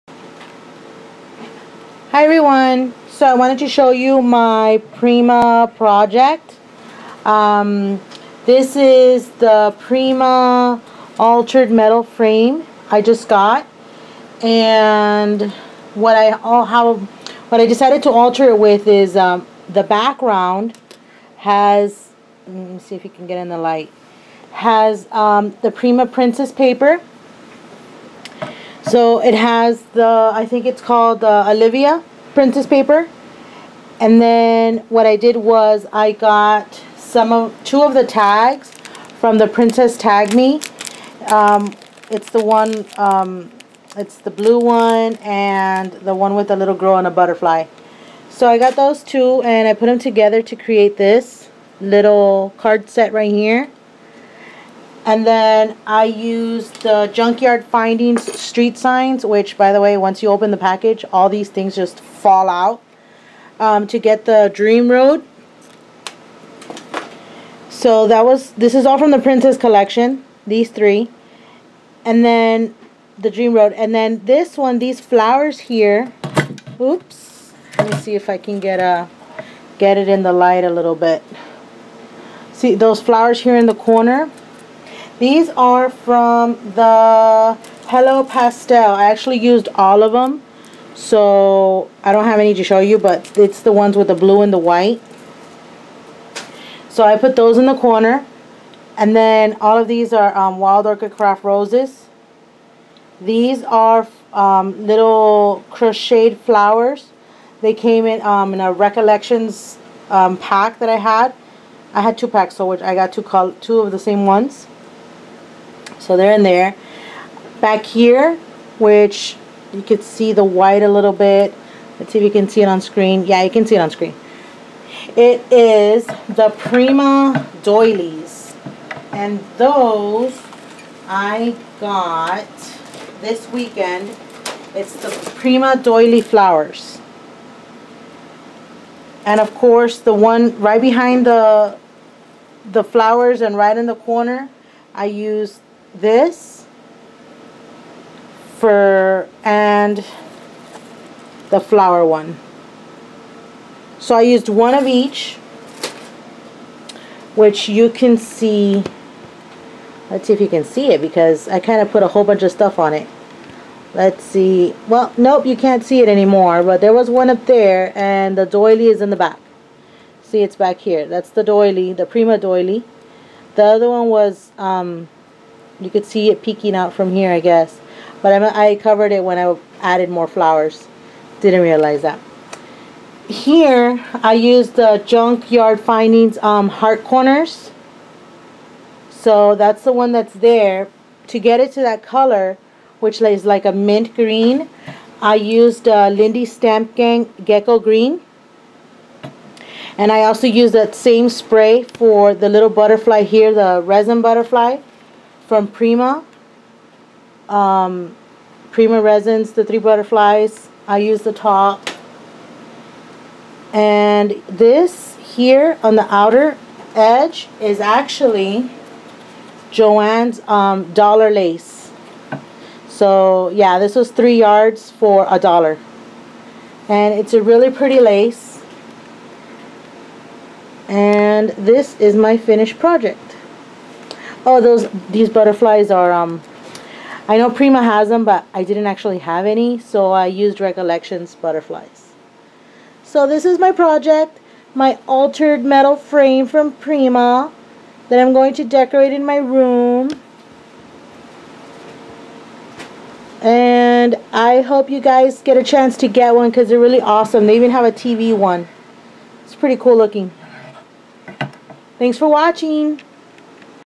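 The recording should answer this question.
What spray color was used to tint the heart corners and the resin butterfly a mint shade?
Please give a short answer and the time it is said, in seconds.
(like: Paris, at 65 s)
Gecko Green, at 197 s.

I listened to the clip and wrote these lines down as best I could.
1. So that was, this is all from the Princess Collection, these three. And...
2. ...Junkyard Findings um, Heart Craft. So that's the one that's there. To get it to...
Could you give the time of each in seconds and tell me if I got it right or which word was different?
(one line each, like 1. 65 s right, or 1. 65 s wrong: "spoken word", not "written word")
1. 67 s right
2. 185 s wrong: "Corners", not "Craft".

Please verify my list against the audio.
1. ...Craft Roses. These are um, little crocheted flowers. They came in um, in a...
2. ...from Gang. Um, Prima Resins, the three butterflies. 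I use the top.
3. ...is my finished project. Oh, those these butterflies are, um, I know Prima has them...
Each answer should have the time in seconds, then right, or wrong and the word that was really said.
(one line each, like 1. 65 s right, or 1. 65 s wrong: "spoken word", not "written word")
1. 101 s right
2. 205 s wrong: "Prima", not "Gang"
3. 231 s right.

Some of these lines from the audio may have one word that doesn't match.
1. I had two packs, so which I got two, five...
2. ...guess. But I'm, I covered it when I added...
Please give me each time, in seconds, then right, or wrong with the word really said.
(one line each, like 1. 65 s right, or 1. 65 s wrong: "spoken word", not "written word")
1. 111 s wrong: "two", not "five"
2. 177 s right.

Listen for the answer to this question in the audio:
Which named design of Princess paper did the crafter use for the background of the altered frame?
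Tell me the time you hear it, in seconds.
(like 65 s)
31 s.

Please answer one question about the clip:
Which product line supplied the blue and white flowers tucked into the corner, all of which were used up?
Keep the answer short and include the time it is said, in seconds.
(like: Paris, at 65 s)
Hello Pastel, at 87 s.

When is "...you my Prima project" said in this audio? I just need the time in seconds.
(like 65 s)
3 s.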